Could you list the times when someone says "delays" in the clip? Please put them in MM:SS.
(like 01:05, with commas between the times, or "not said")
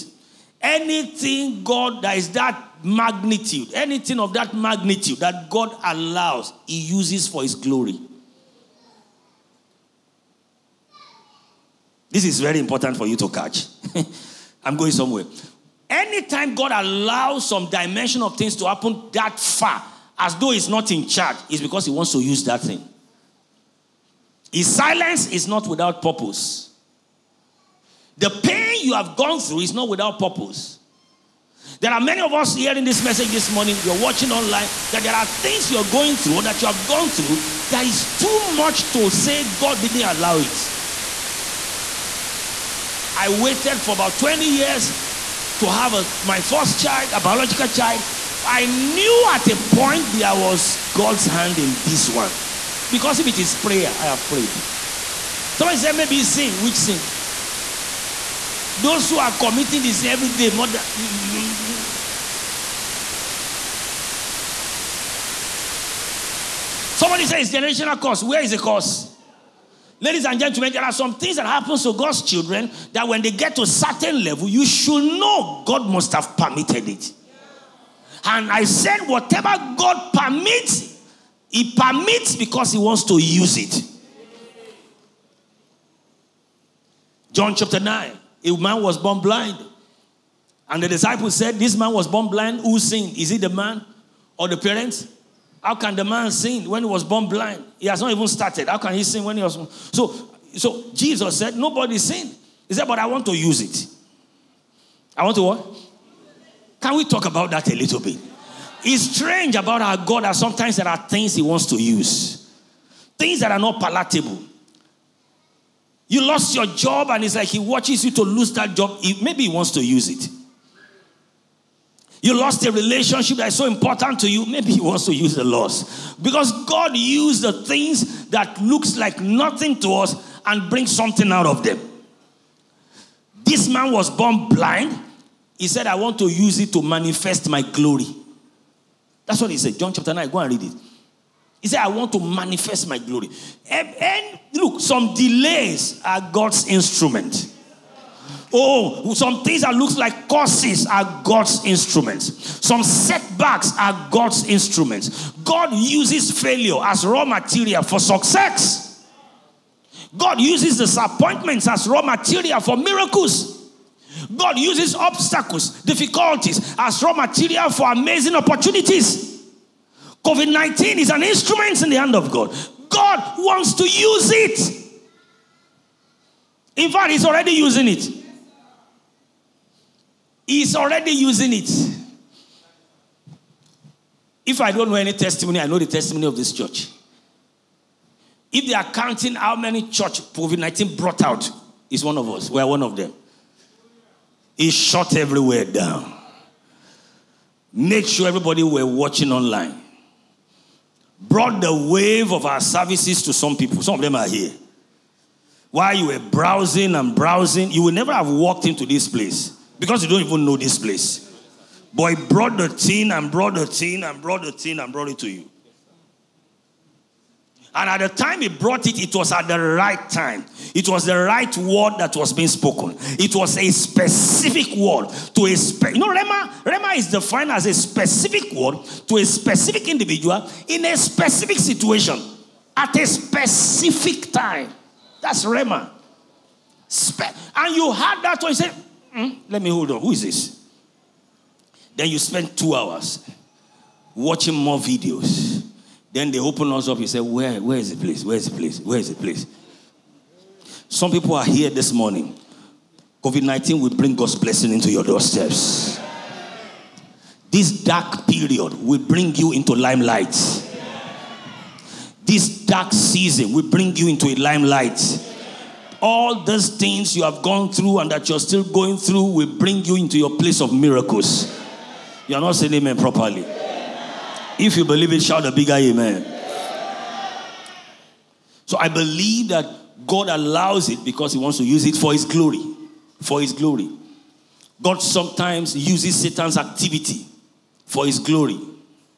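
02:25.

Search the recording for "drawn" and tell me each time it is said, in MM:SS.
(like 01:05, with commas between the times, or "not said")
not said.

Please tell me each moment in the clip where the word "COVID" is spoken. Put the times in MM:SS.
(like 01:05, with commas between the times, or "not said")
02:50, 03:10, 04:13.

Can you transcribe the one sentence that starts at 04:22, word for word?
This dark season will bring you into a limelight.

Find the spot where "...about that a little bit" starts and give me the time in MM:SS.
01:47.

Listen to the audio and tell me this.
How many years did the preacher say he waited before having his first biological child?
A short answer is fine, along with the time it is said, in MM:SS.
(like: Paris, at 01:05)
20, at 00:44.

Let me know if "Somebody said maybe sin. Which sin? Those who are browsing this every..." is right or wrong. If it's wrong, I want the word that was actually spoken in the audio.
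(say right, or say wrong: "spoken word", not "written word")
wrong: "committing", not "browsing".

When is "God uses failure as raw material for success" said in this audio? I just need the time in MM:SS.
02:35.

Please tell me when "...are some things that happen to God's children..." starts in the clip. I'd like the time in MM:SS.
01:10.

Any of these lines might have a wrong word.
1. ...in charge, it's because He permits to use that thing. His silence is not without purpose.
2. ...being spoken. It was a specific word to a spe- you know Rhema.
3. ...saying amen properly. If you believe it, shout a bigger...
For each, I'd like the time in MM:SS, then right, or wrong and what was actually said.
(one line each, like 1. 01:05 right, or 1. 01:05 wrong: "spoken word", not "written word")
1. 00:20 wrong: "wants", not "permits"
2. 03:42 right
3. 04:32 right.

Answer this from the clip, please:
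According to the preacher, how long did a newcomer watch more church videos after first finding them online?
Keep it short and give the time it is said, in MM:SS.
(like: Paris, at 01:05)
2 hours, at 04:02.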